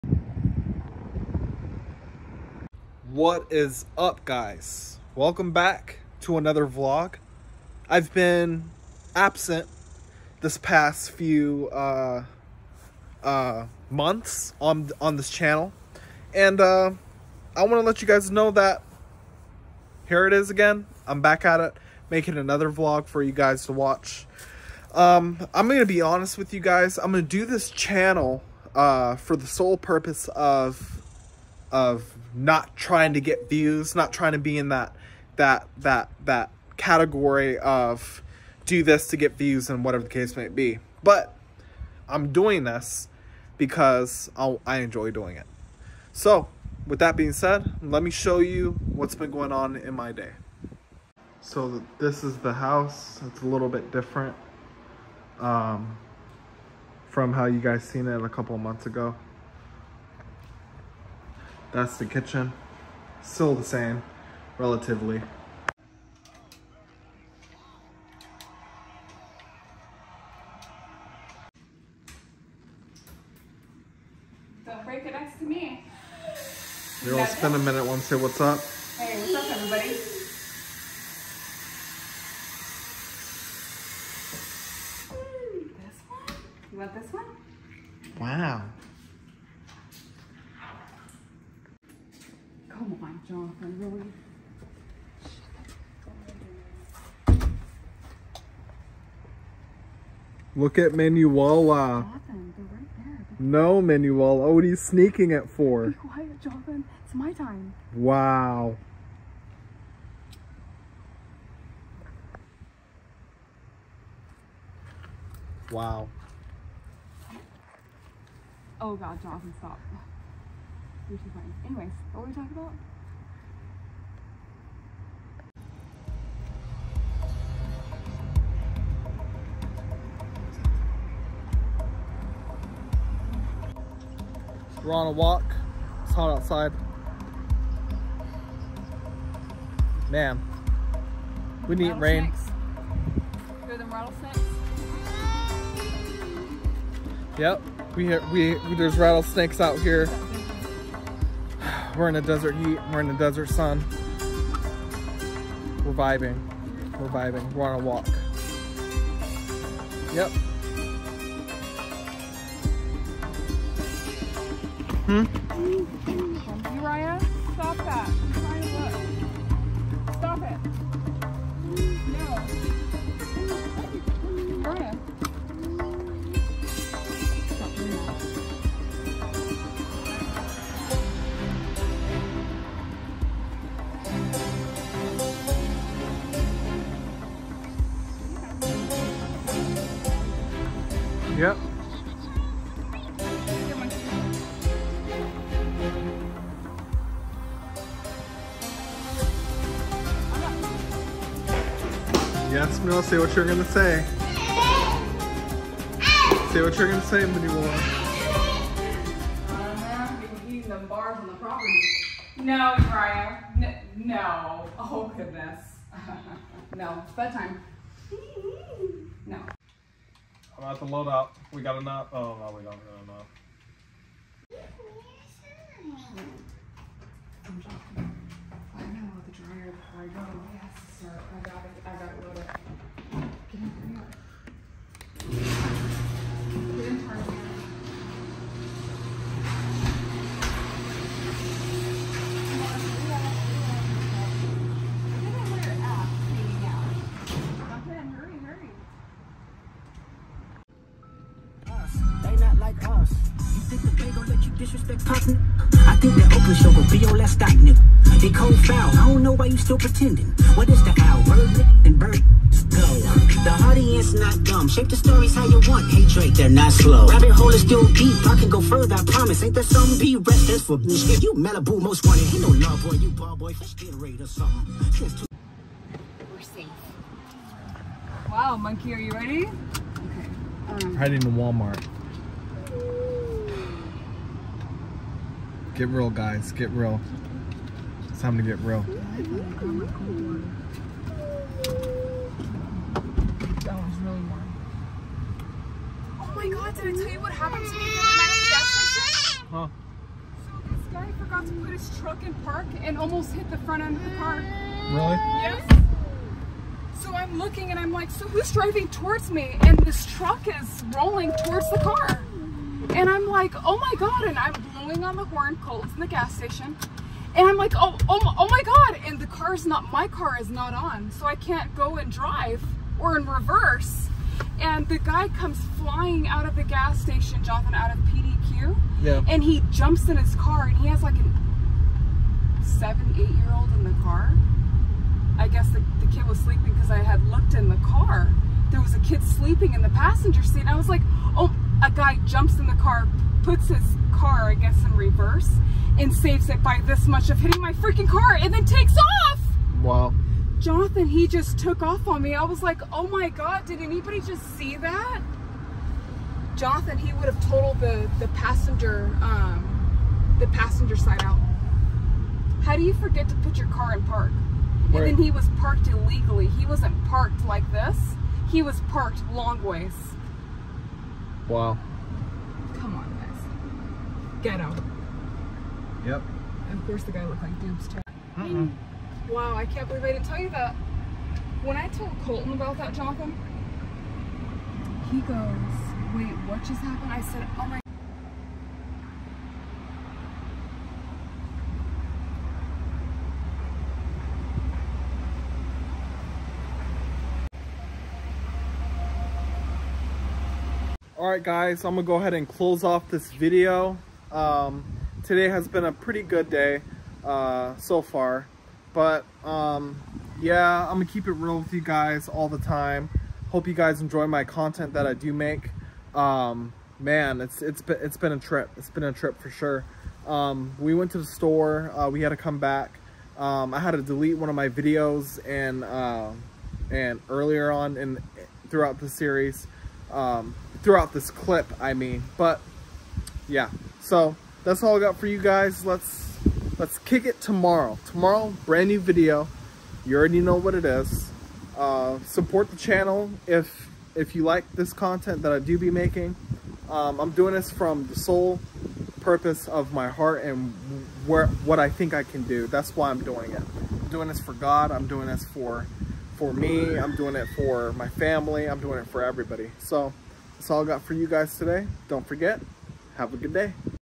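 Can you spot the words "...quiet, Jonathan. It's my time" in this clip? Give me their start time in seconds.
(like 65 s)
105 s.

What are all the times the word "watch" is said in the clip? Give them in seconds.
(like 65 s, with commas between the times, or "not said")
23 s.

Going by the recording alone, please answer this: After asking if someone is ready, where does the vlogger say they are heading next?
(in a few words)
Walmart.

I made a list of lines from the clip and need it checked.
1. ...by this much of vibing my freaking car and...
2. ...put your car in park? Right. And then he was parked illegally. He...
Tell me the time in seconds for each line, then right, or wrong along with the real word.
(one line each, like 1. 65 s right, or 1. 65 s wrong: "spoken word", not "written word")
1. 346 s wrong: "hitting", not "vibing"
2. 363 s right.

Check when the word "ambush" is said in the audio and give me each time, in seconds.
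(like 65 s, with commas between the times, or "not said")
not said.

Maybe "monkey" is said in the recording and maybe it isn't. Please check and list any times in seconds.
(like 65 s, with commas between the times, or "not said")
278 s.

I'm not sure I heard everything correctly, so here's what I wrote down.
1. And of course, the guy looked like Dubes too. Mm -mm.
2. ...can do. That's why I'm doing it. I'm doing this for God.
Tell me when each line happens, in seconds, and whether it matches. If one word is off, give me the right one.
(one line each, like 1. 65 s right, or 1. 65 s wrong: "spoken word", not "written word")
1. 376 s right
2. 452 s right.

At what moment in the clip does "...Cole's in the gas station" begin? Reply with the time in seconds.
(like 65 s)
315 s.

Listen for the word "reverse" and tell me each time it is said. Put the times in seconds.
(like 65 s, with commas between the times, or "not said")
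323 s, 344 s.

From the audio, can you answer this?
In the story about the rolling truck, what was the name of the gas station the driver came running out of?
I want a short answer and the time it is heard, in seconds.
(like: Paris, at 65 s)
PDQ, at 328 s.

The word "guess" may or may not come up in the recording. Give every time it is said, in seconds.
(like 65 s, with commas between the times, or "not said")
335 s, 344 s.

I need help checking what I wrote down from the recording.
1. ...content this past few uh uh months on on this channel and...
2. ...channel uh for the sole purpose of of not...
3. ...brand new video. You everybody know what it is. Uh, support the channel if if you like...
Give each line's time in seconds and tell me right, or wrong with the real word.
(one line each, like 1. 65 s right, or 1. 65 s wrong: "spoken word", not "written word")
1. 9 s wrong: "absent", not "content"
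2. 27 s right
3. 438 s wrong: "already", not "everybody".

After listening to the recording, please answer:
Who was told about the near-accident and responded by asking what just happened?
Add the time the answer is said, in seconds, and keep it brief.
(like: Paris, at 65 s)
Colton, at 382 s.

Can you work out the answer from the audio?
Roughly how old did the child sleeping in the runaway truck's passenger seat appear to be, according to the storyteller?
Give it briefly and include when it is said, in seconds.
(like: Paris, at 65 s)
7 or 8, at 332 s.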